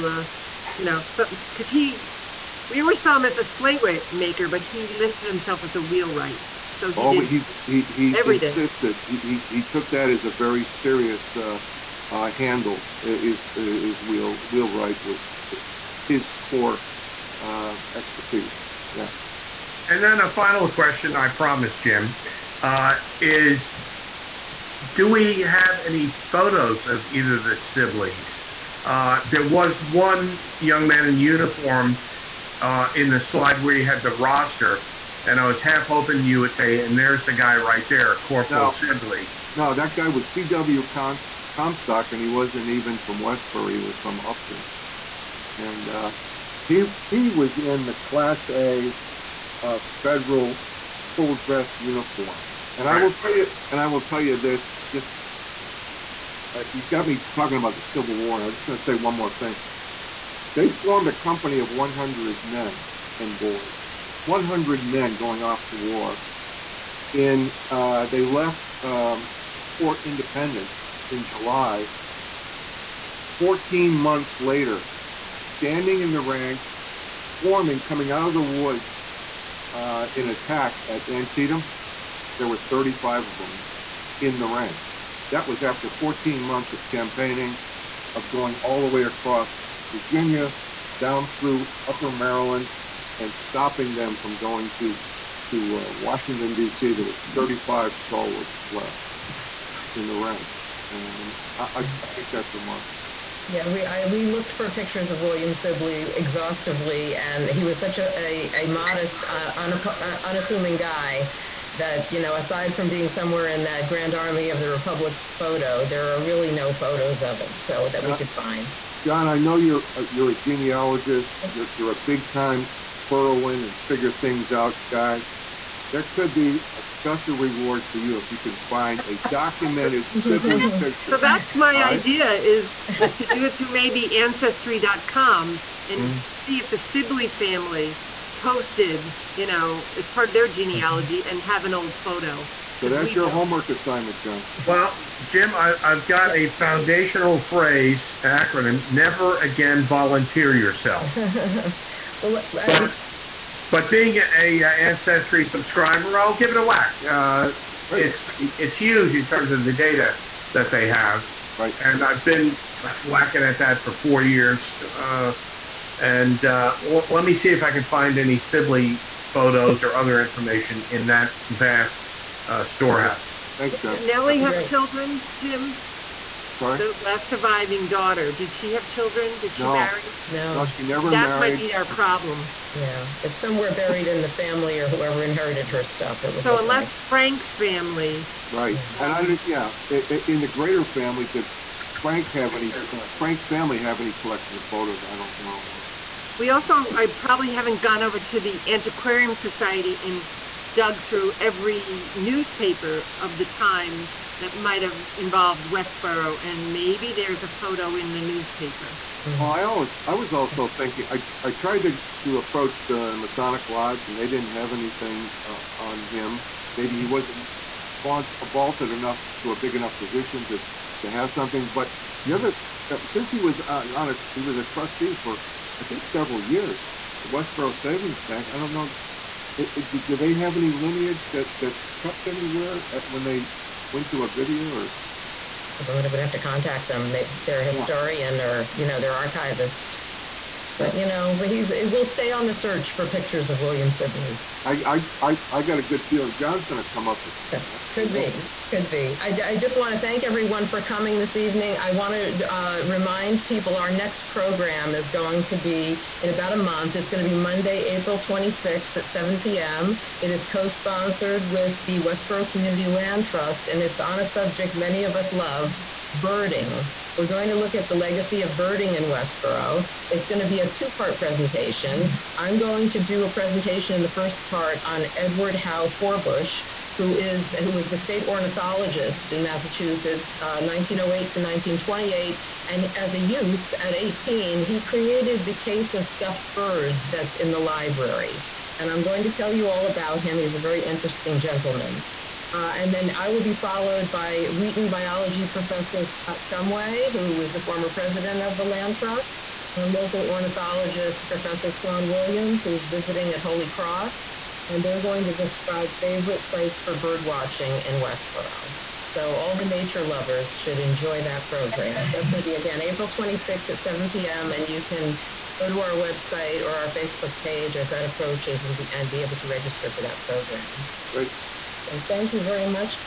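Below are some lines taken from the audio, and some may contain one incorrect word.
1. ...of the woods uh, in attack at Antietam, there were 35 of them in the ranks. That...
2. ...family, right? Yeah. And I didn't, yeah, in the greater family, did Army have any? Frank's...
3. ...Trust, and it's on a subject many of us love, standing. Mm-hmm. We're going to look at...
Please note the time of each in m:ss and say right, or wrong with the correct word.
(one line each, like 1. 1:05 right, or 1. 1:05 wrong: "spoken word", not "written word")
1. 1:18 right
2. 3:07 wrong: "Frank", not "Army"
3. 4:23 wrong: "birding", not "standing".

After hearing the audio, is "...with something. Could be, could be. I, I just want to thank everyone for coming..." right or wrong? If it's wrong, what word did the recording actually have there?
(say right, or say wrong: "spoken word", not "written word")
right.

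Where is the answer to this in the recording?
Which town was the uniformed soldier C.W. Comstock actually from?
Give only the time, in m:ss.
0:44.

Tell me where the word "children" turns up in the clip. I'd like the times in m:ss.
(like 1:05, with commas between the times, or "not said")
2:54, 2:58.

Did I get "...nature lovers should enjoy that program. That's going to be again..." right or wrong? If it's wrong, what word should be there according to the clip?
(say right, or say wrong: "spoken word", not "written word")
right.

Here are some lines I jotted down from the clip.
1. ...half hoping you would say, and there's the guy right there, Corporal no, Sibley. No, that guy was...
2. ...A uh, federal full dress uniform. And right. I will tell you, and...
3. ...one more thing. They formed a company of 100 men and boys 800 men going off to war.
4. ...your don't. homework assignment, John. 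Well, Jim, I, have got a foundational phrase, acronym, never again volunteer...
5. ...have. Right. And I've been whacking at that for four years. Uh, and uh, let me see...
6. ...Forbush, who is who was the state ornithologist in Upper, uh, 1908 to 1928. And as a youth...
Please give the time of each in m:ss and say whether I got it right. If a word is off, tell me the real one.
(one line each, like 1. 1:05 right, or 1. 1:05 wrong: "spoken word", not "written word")
1. 0:35 right
2. 0:48 right
3. 0:58 wrong: "100", not "800"
4. 2:23 right
5. 2:40 right
6. 4:35 wrong: "Massachusetts", not "Upper".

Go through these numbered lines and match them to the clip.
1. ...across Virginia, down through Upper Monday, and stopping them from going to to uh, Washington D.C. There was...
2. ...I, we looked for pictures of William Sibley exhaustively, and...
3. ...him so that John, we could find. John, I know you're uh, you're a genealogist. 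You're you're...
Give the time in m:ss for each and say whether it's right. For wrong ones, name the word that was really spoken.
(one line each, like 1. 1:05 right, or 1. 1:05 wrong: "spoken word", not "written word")
1. 1:29 wrong: "Maryland", not "Monday"
2. 1:43 right
3. 1:57 right.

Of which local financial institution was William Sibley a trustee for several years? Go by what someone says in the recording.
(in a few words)
Westboro Savings Bank.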